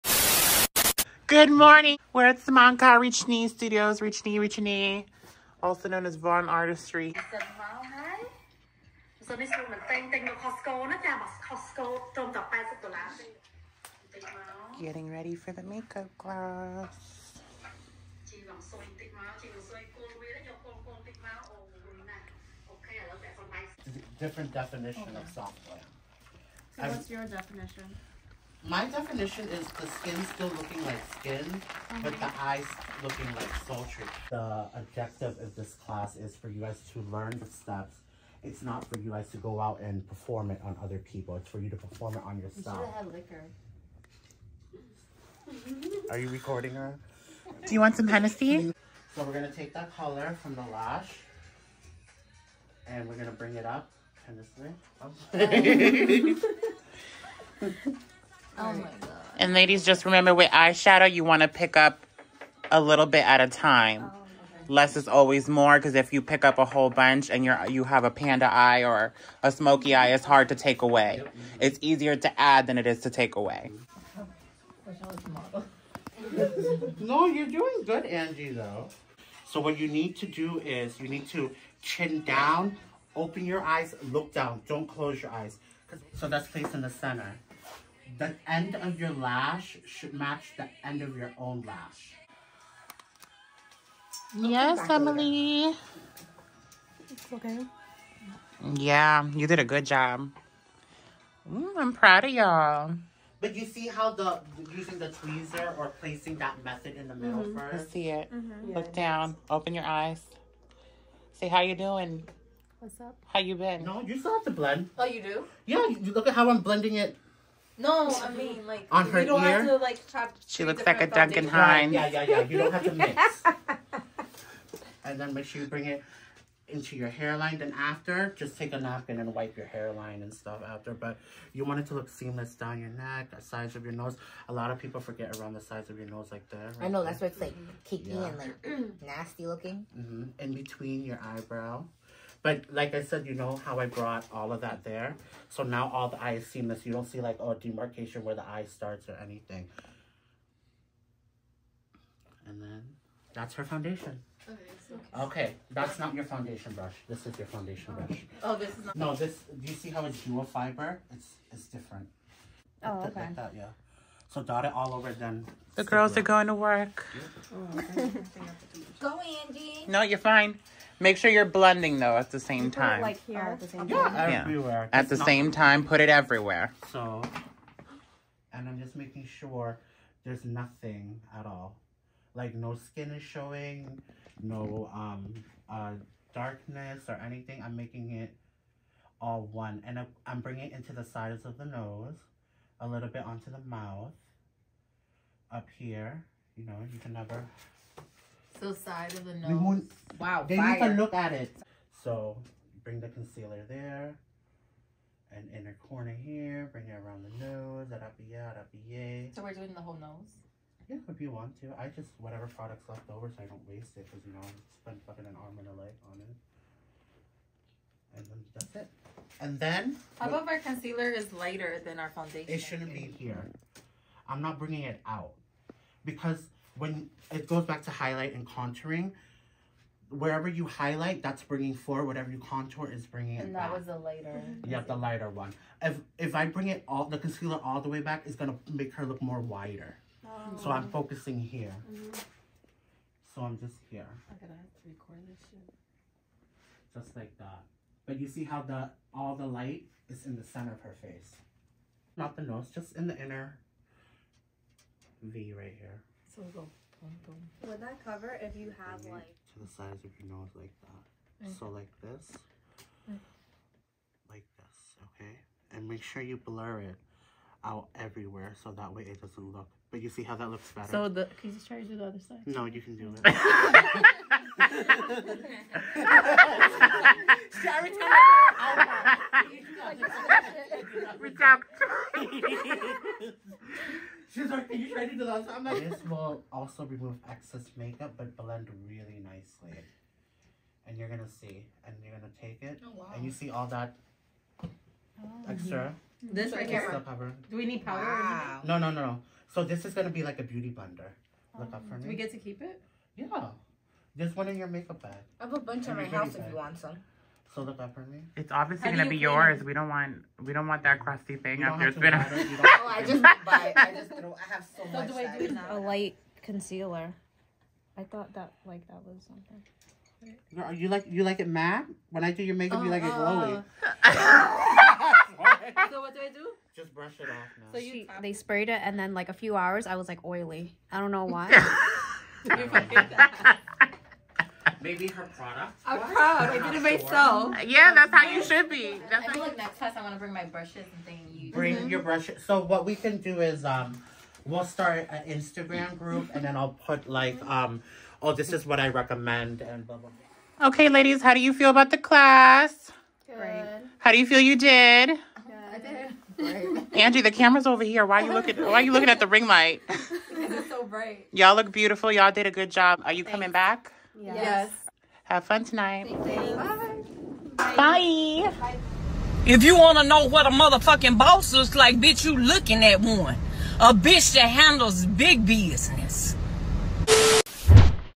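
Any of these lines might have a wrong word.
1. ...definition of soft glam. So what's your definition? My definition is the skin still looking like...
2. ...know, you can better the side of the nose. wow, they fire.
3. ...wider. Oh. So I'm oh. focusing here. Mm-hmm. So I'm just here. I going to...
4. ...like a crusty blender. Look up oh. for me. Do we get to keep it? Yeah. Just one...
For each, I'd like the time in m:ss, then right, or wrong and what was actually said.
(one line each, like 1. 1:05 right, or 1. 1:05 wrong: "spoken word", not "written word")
1. 0:24 right
2. 3:16 wrong: "never", not "better"
3. 3:59 right
4. 5:00 wrong: "beauty", not "crusty".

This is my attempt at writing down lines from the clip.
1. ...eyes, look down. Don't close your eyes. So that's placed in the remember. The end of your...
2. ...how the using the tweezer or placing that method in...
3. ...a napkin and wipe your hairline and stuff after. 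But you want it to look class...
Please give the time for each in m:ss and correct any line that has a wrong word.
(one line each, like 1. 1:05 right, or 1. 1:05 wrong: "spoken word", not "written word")
1. 1:23 wrong: "center", not "remember"
2. 1:43 right
3. 2:08 wrong: "seamless", not "class".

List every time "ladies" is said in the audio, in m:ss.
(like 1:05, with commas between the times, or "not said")
0:59, 5:50.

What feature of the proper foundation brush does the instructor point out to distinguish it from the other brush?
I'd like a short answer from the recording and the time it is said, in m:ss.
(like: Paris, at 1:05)
Dual fiber, at 2:40.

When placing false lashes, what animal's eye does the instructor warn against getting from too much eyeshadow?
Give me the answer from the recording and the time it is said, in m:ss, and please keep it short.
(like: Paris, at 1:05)
Panda, at 1:08.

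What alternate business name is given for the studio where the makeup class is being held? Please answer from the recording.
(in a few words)
Voeun Artistry.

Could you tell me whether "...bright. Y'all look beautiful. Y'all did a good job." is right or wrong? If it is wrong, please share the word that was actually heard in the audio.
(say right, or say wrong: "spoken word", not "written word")
right.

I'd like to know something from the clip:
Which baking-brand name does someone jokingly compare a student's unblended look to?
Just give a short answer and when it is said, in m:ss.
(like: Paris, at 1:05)
Duncan Hines, at 2:01.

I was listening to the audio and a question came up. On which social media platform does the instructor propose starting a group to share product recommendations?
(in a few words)
Instagram.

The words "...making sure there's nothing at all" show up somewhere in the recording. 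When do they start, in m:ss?
2:58.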